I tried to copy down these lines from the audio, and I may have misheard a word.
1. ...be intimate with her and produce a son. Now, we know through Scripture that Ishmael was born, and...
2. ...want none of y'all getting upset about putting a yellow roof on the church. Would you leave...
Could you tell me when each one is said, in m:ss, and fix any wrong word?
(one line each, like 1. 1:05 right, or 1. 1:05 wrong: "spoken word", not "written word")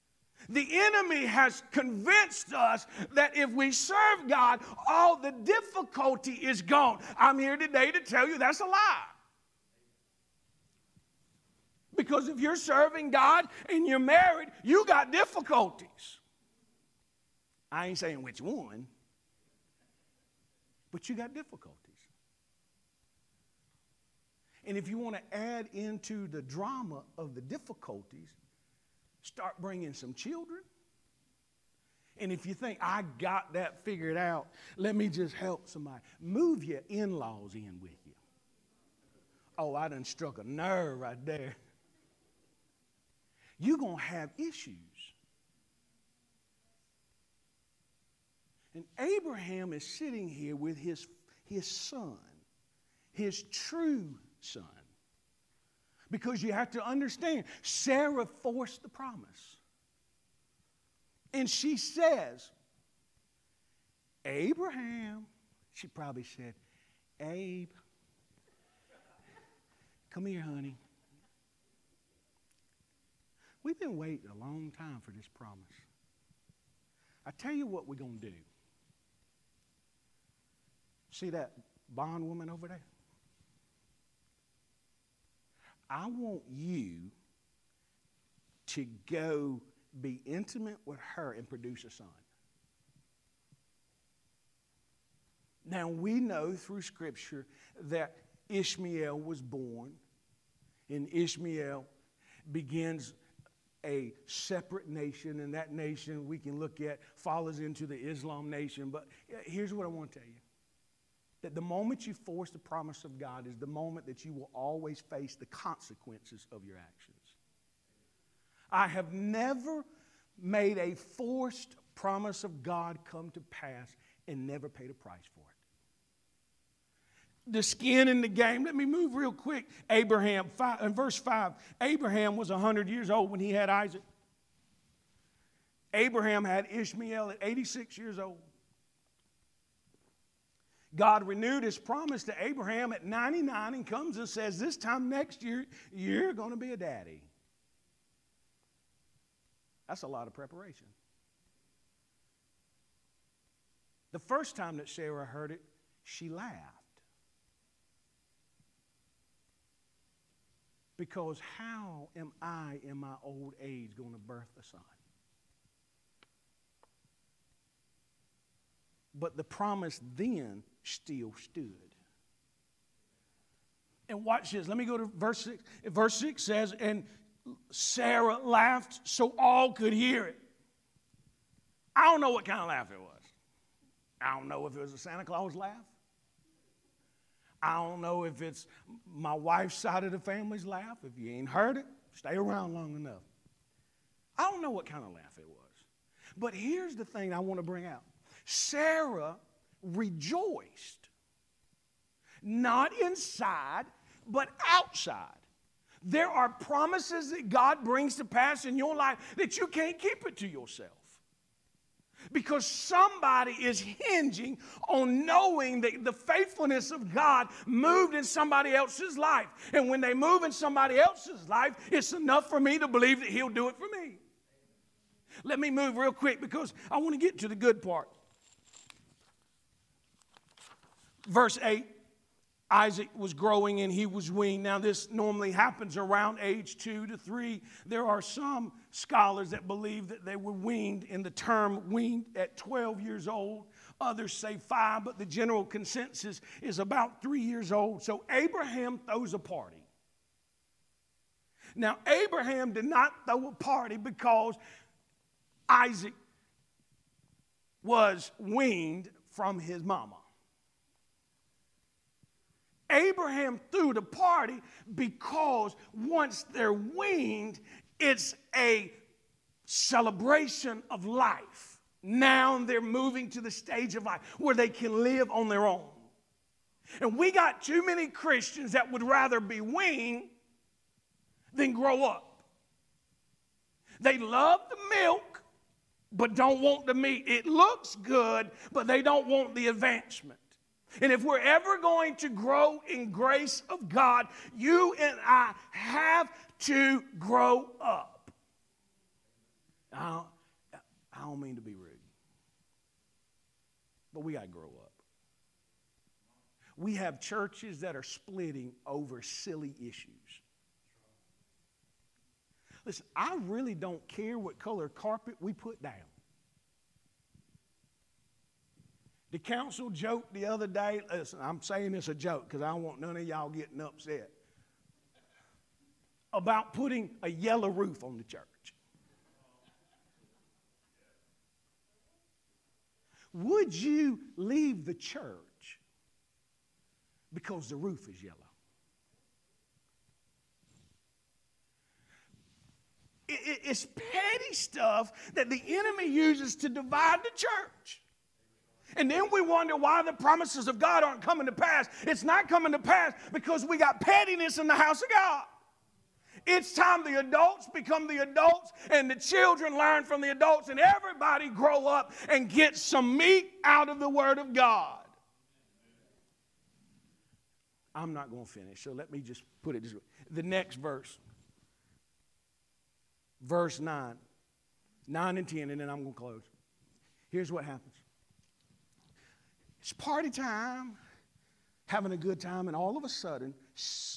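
1. 1:30 right
2. 5:22 right.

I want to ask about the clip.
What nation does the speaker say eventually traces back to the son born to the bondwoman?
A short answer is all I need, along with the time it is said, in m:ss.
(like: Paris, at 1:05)
Islam nation, at 1:47.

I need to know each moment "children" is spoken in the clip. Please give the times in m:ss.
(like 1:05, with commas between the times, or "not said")
0:30, 5:59.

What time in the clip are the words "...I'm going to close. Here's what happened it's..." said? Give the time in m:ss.
6:15.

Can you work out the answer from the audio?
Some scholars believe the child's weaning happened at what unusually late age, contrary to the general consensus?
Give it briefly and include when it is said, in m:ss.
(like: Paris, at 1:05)
12, at 4:02.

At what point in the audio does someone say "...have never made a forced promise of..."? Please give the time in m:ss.
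1:58.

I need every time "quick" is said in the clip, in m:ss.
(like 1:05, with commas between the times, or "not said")
2:09, 3:46.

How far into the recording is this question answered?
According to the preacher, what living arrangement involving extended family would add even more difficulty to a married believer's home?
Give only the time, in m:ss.
0:36.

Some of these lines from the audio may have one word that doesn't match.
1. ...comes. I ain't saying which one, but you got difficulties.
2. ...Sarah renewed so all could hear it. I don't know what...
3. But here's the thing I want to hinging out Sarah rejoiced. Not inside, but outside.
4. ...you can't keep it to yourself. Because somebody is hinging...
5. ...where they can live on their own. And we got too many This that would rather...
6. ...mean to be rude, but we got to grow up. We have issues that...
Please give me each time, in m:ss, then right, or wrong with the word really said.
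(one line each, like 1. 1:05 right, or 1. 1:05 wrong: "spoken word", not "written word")
1. 0:15 wrong: "difficulties", not "comes"
2. 2:57 wrong: "laughed", not "renewed"
3. 3:16 wrong: "bring", not "hinging"
4. 3:29 right
5. 4:34 wrong: "Christians", not "This"
6. 5:01 wrong: "churches", not "issues".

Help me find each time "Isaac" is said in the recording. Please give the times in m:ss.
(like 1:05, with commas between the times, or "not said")
2:13, 3:52, 4:15.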